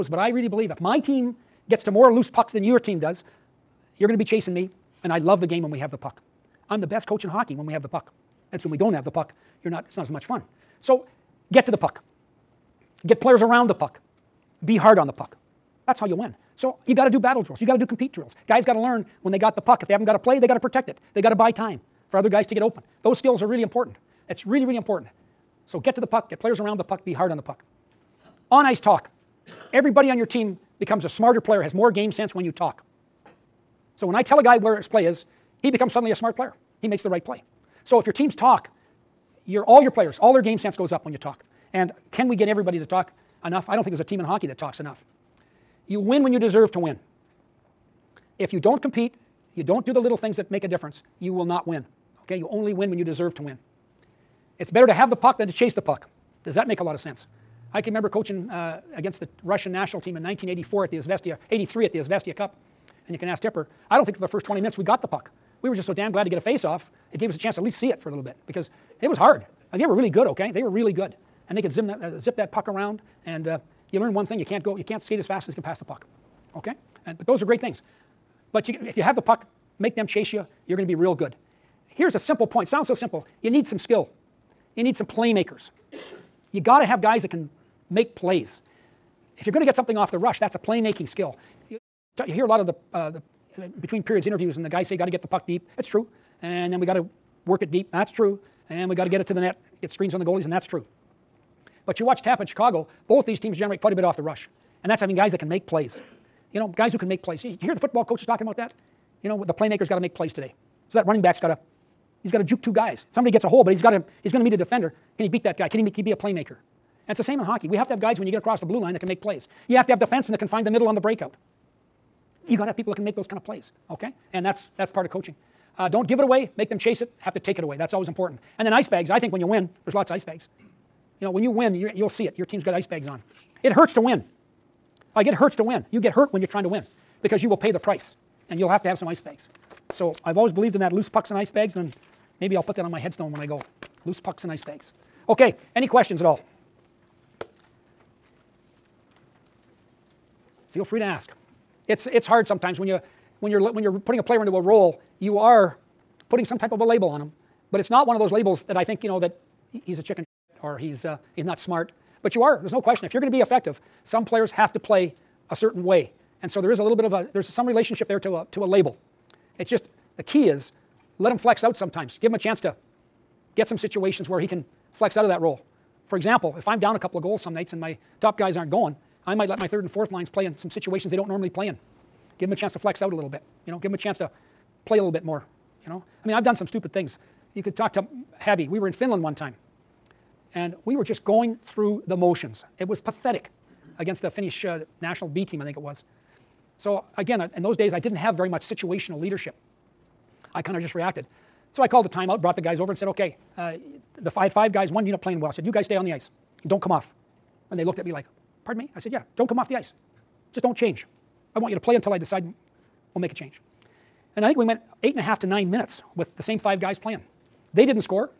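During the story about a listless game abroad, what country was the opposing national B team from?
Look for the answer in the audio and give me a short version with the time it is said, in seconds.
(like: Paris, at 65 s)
Finland, at 194 s.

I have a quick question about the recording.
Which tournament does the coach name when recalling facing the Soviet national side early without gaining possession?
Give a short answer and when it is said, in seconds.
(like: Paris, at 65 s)
Izvestia Cup, at 61 s.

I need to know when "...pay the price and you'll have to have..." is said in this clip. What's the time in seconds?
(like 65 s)
137 s.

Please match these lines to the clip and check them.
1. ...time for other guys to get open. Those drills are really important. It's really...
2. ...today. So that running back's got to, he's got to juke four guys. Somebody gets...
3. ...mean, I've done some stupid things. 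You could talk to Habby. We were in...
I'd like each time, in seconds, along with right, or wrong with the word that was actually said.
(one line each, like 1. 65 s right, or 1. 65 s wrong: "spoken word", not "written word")
1. 21 s wrong: "skills", not "drills"
2. 110 s wrong: "two", not "four"
3. 186 s right.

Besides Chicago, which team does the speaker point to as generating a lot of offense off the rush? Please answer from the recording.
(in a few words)
Tampa.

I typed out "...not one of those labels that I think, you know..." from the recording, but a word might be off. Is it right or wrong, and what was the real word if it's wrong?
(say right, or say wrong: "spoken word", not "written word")
right.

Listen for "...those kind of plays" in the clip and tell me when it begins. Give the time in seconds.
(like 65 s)
123 s.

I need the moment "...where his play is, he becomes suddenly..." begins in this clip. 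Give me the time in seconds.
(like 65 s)
34 s.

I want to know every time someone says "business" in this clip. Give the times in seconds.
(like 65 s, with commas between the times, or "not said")
not said.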